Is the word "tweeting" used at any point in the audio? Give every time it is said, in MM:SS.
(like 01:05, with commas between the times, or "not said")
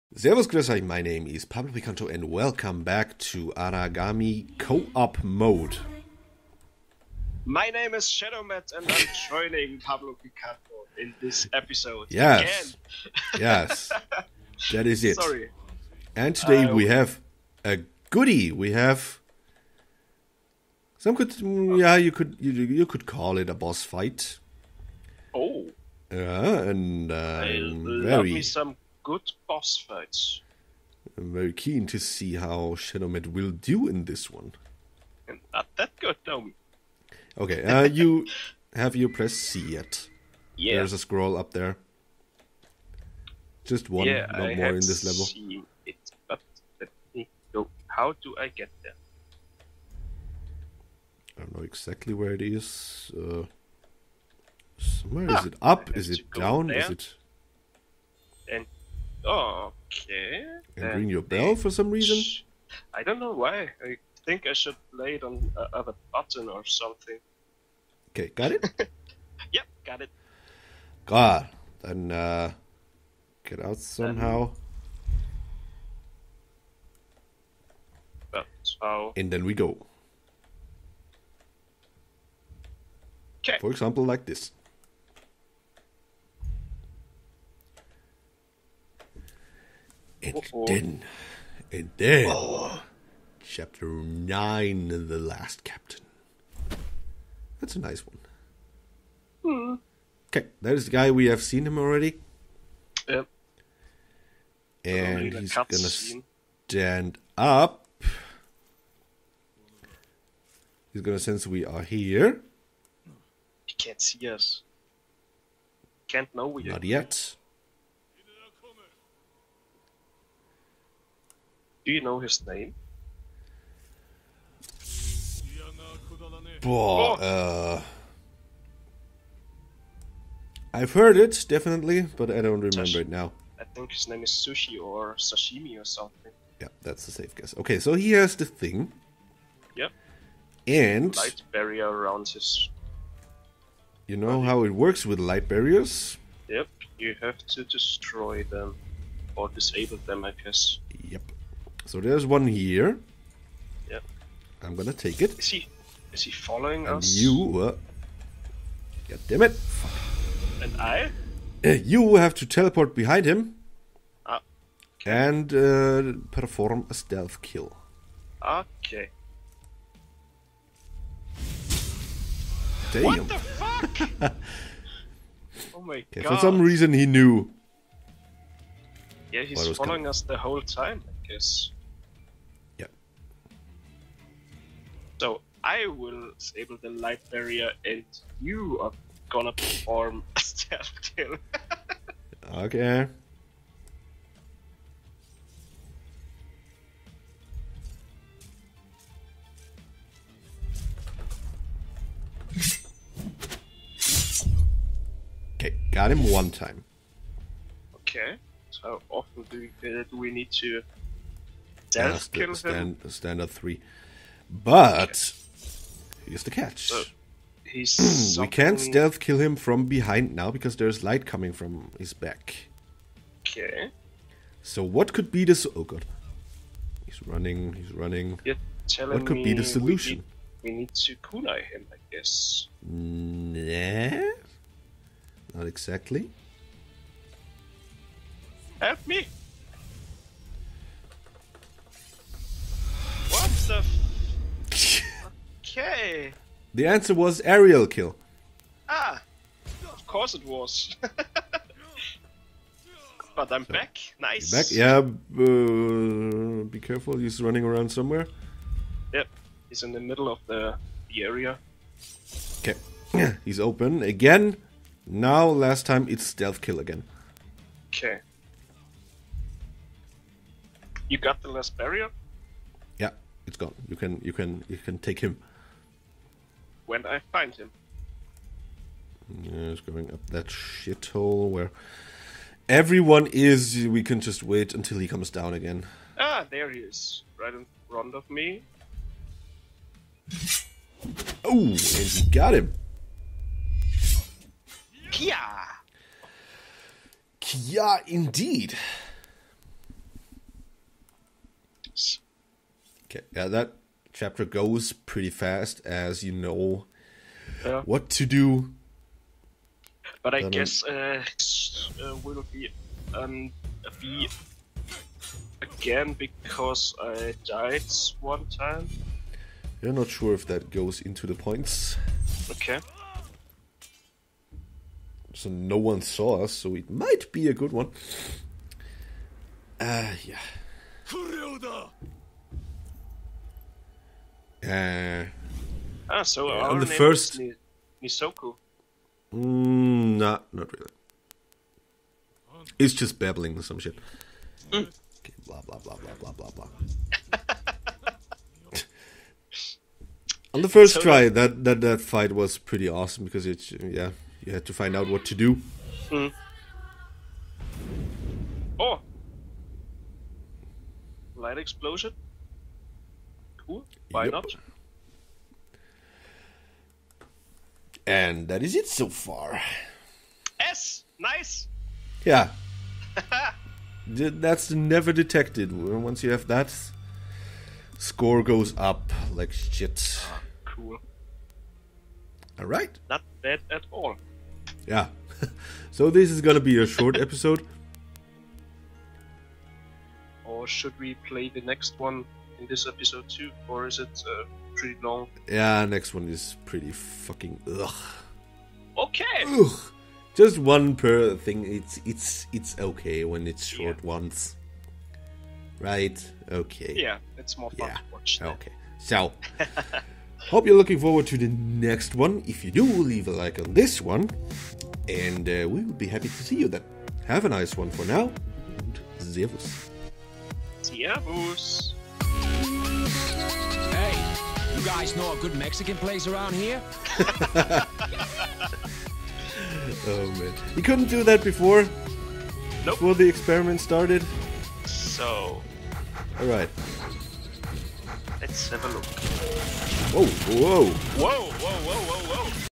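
not said.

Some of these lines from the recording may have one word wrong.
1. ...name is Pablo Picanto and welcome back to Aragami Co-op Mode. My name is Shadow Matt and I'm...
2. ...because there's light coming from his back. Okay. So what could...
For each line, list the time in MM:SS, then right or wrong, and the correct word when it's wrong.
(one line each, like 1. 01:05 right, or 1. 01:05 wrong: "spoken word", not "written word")
1. 00:01 right
2. 03:40 right.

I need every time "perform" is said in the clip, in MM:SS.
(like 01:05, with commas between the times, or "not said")
02:46, 03:09.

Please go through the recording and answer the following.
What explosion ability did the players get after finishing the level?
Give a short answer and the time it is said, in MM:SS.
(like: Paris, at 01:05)
Light explosion, at 06:01.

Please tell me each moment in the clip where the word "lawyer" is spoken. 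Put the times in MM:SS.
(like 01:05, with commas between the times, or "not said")
not said.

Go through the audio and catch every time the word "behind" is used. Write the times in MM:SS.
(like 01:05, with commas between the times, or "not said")
02:42, 03:39.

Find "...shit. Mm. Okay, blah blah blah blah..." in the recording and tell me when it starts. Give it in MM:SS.
05:43.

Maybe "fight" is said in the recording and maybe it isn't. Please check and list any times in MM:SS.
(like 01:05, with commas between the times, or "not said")
00:23, 00:29, 05:51.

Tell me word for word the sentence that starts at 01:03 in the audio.
I think I should play it on a, on a button or something.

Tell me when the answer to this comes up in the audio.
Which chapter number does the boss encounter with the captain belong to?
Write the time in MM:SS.
01:33.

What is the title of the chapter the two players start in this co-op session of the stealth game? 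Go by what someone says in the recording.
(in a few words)
The Last Captain.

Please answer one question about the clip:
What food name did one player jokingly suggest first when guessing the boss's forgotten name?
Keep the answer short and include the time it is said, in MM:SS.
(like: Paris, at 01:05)
Sushi, at 02:14.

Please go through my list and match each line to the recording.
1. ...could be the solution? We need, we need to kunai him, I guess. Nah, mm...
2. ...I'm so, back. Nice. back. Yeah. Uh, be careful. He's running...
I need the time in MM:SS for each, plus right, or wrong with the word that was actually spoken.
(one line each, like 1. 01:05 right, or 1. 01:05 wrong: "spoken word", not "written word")
1. 03:49 right
2. 04:13 right.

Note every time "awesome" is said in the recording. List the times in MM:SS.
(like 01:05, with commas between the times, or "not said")
05:52.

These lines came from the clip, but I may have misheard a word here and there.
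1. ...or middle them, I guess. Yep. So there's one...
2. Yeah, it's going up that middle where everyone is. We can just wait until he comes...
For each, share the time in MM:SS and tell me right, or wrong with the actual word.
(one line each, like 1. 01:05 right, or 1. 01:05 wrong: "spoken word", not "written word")
1. 02:29 wrong: "disable", not "middle"
2. 04:39 wrong: "shithole", not "middle".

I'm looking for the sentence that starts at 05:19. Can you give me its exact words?
You're not sure if that goes into the points.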